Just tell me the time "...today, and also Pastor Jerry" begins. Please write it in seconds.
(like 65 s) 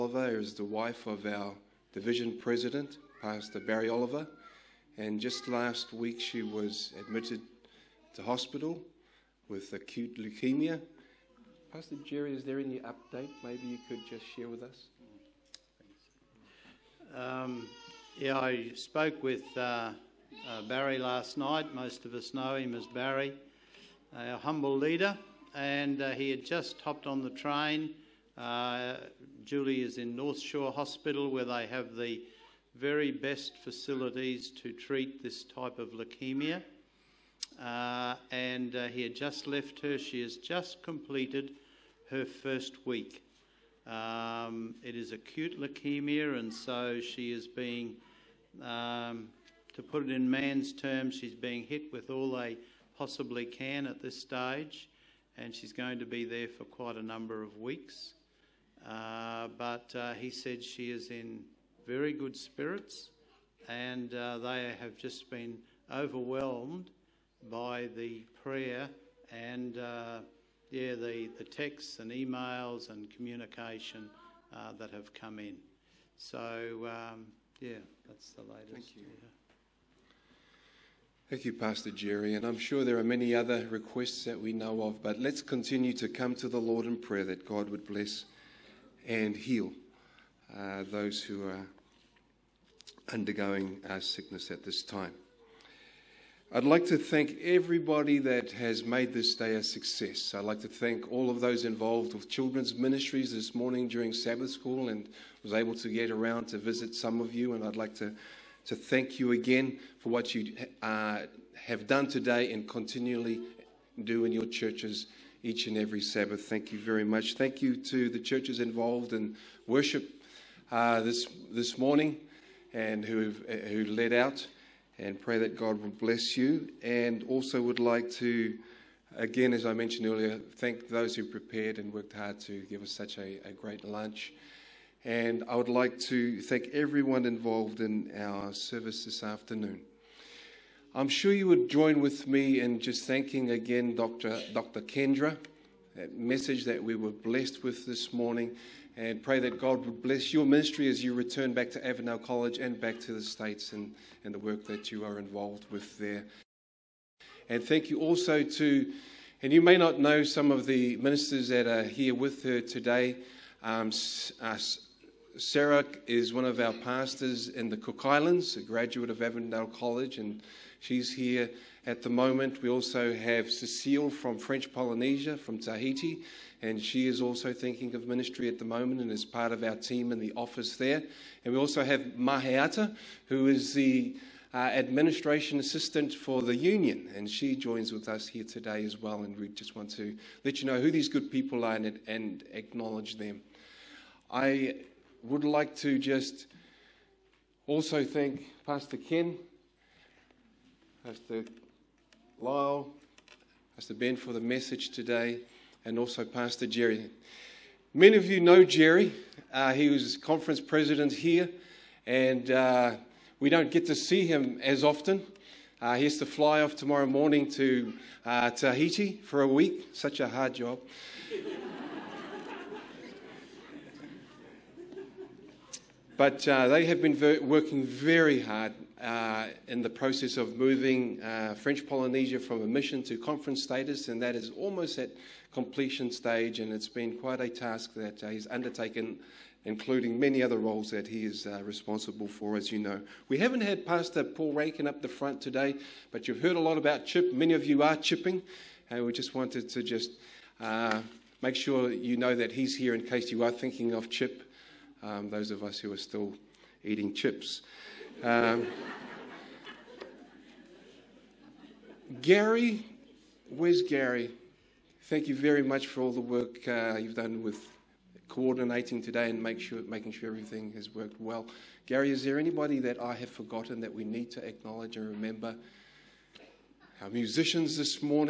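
204 s.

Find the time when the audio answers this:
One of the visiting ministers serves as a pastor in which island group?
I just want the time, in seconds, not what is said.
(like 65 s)
167 s.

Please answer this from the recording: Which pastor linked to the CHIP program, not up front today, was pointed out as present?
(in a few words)
Paul Rankin.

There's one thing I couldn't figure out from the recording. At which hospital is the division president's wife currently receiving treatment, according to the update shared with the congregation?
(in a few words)
North Shore Hospital.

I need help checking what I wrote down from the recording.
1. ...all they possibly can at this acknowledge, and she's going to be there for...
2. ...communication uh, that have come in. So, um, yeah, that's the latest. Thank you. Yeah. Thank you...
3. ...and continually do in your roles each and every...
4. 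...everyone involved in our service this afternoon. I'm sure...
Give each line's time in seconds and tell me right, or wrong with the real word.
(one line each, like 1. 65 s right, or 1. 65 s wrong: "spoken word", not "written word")
1. 52 s wrong: "stage", not "acknowledge"
2. 73 s right
3. 112 s wrong: "churches", not "roles"
4. 136 s right.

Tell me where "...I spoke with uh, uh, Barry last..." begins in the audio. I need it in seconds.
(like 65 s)
18 s.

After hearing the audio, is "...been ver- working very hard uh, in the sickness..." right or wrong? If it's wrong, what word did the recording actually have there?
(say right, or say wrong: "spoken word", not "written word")
wrong: "process", not "sickness".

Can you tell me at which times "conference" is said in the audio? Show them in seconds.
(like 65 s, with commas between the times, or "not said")
210 s, 233 s.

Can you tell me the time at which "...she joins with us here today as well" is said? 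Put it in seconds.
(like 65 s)
187 s.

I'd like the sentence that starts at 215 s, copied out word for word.
Uh, he has to fly off tomorrow morning to uh, Tahiti for a week.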